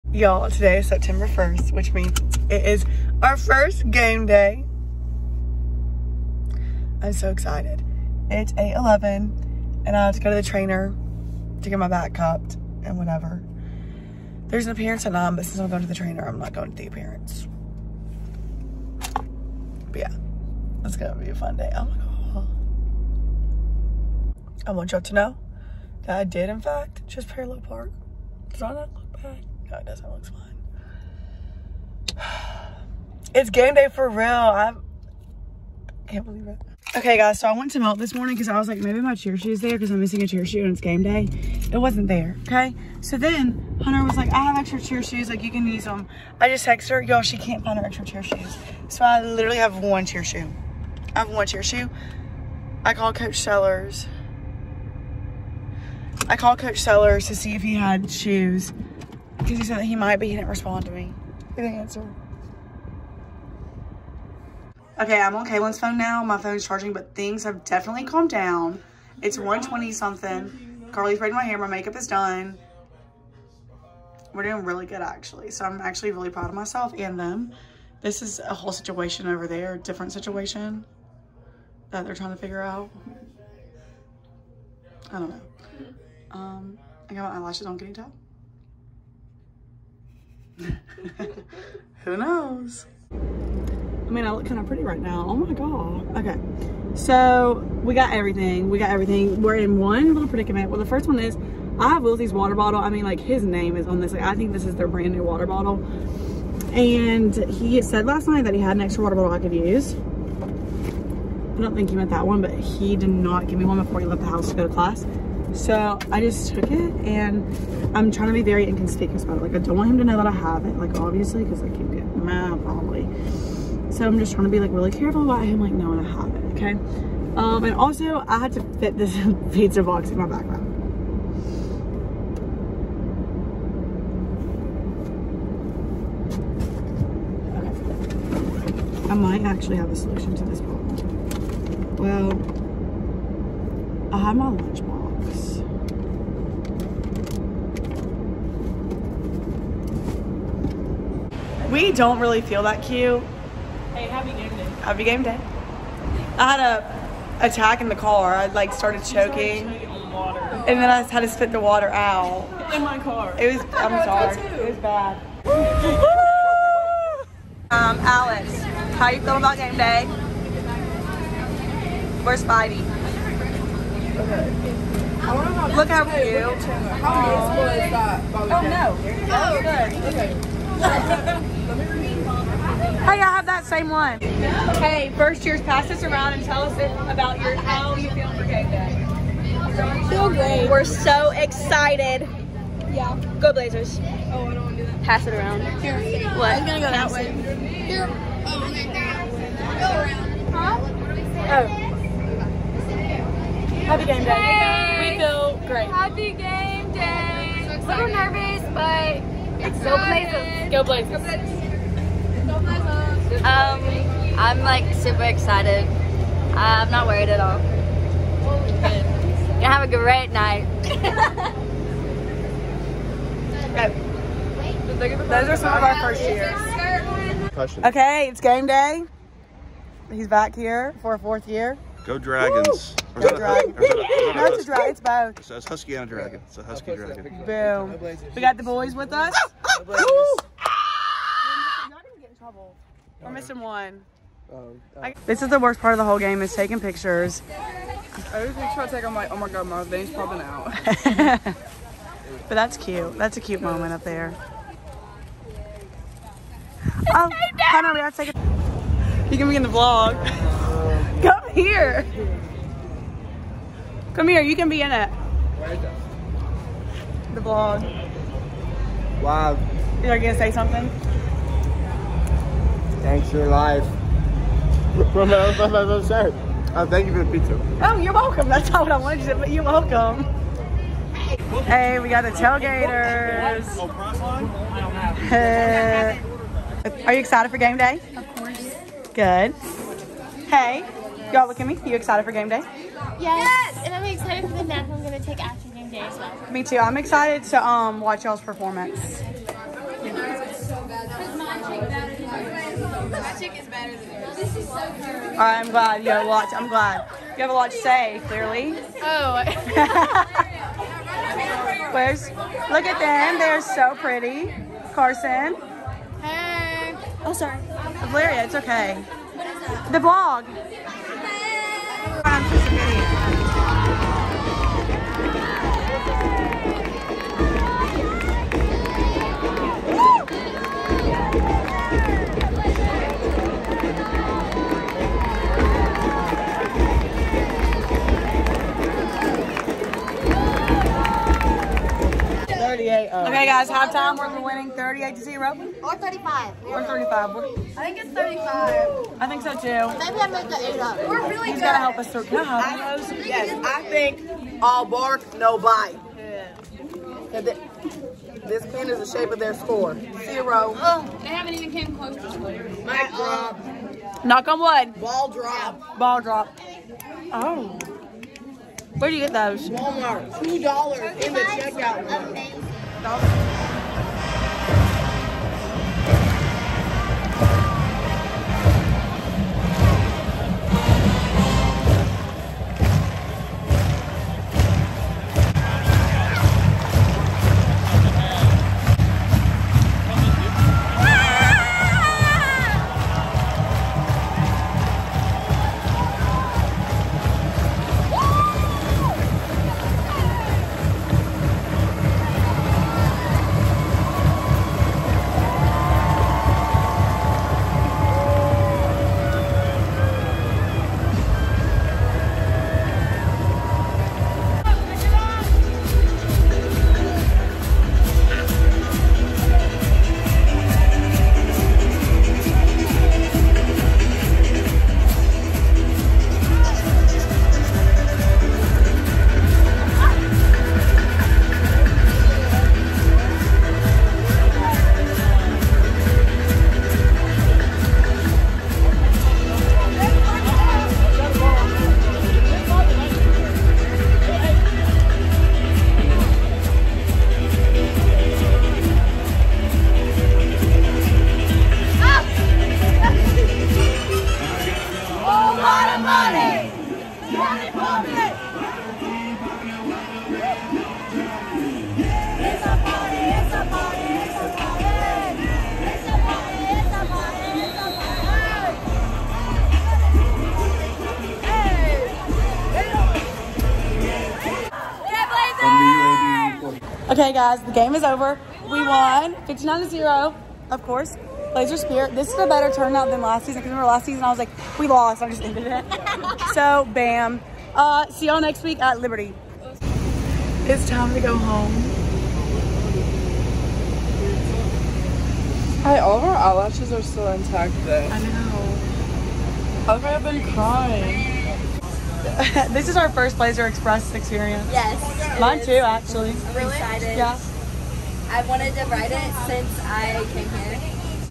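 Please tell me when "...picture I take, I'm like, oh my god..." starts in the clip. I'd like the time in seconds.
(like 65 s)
248 s.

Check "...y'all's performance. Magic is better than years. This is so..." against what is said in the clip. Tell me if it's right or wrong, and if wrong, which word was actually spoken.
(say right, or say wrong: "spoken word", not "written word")
wrong: "yours", not "years".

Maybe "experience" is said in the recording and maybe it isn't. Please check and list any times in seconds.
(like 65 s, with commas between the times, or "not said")
504 s.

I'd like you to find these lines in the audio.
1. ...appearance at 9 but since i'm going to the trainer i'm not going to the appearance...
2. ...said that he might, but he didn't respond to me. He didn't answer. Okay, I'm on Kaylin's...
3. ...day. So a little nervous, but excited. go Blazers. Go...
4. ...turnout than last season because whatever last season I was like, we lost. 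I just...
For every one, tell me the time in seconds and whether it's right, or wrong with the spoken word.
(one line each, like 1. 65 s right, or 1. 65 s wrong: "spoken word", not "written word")
1. 14 s right
2. 59 s right
3. 206 s right
4. 482 s wrong: "remember", not "whatever".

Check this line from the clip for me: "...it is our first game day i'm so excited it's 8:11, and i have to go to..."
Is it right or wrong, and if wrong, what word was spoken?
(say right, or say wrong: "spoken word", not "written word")
right.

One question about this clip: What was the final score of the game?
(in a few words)
59 to 0.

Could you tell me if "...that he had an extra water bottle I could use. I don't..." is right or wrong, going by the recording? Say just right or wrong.
right.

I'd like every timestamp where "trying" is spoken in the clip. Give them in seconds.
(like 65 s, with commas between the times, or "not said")
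82 s, 118 s, 124 s.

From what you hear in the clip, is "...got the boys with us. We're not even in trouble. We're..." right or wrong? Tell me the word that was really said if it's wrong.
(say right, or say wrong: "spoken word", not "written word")
right.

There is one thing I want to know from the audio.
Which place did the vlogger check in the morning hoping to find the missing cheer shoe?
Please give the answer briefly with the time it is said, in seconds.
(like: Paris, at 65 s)
Melt, at 37 s.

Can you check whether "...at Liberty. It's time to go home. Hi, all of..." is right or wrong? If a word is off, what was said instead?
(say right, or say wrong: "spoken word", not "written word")
right.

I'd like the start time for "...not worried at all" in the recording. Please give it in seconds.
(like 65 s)
216 s.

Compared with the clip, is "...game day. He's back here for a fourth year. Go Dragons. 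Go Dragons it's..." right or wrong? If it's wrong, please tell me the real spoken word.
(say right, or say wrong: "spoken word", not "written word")
right.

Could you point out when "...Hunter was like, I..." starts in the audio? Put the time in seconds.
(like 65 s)
43 s.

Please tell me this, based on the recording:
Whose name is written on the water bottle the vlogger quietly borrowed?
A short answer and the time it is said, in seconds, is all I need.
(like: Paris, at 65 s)
Wilsey, at 102 s.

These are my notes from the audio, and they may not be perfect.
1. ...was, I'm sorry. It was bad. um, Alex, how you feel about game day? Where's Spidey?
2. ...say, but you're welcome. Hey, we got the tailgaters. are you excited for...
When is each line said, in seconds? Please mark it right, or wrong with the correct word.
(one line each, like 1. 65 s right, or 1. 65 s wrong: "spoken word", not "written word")
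1. 163 s right
2. 279 s right.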